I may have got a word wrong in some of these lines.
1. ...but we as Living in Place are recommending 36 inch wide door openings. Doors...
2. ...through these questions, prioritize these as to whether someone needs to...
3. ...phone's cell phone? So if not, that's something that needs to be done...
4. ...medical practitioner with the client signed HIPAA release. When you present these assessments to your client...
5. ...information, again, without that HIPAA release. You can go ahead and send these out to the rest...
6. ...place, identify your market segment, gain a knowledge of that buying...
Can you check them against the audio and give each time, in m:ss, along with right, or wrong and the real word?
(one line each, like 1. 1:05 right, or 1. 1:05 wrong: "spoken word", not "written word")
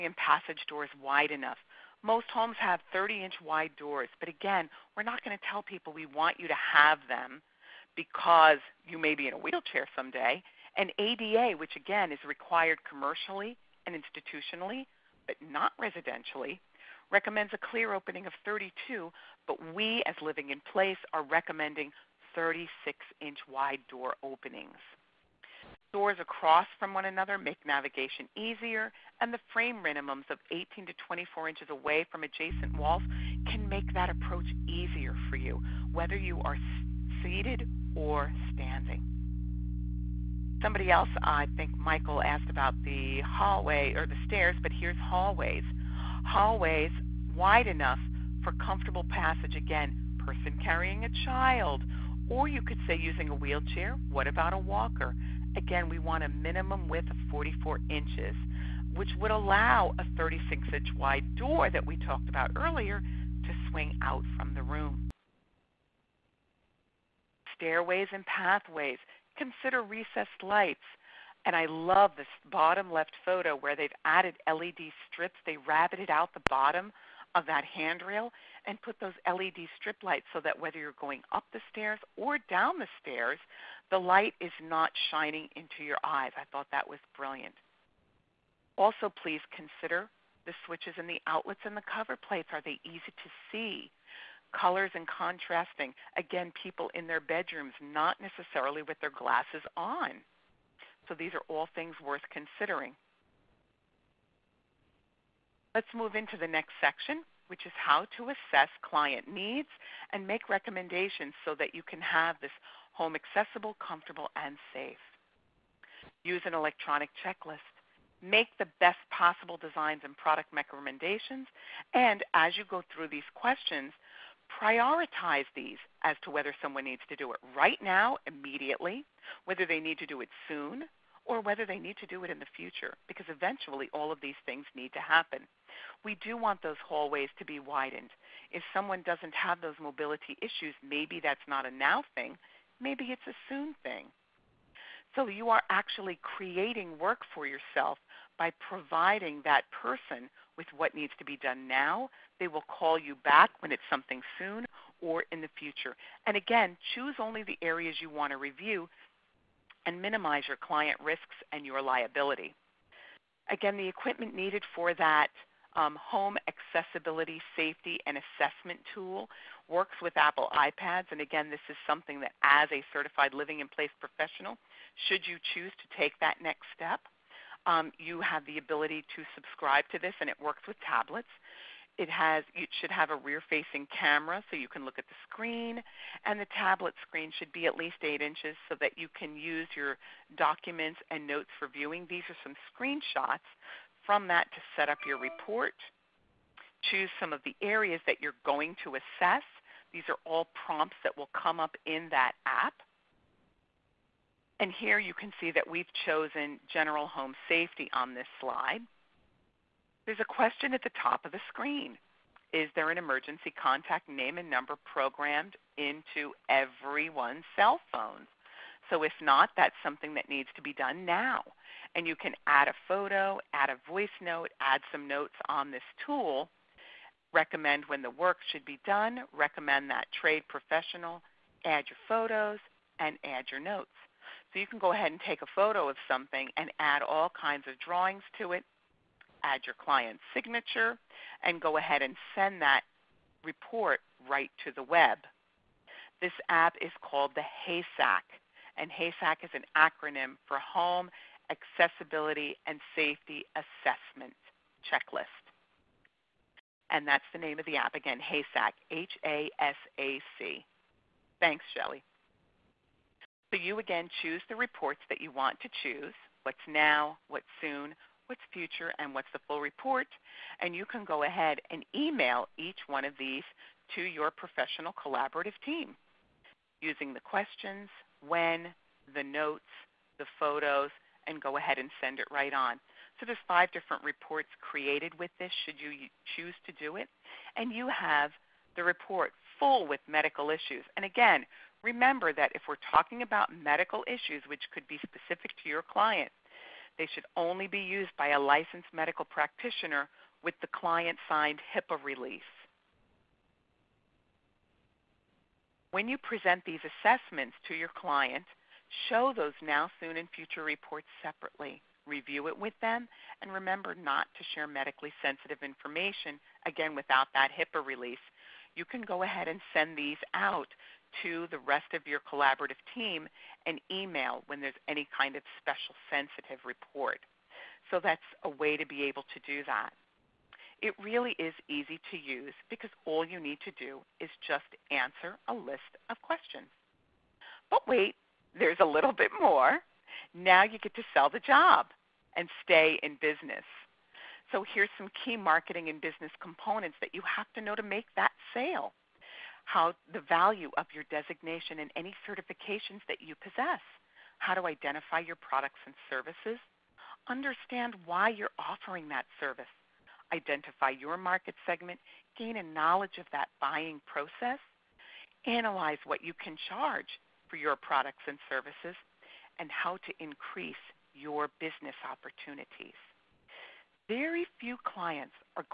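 1. 0:19 right
2. 2:02 right
3. 3:36 wrong: "everyone", not "phone"
4. 4:58 right
5. 5:15 right
6. 5:59 wrong: "service", not "place".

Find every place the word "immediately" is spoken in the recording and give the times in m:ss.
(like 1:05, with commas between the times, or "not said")
2:08.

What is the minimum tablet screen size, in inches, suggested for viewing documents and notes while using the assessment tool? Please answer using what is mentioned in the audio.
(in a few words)
8.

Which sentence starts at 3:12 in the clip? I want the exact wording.
These are some screenshots from that to set up your report.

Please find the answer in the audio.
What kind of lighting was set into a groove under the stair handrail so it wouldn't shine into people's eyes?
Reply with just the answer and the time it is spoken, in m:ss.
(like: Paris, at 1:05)
LED strips, at 1:14.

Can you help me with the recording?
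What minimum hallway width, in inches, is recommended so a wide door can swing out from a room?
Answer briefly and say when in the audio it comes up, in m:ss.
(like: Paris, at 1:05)
44 inches, at 0:57.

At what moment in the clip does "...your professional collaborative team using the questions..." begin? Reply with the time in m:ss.
4:34.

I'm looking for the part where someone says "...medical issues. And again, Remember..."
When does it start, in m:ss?
4:50.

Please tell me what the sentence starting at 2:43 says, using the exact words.
Again, the equipment needed for that um, home accessibility, safety, and assessment tool works with Apple iPads.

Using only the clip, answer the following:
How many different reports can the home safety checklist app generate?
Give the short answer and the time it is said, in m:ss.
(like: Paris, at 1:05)
5, at 4:43.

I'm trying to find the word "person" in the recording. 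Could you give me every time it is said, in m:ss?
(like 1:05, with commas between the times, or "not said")
0:50, 2:29.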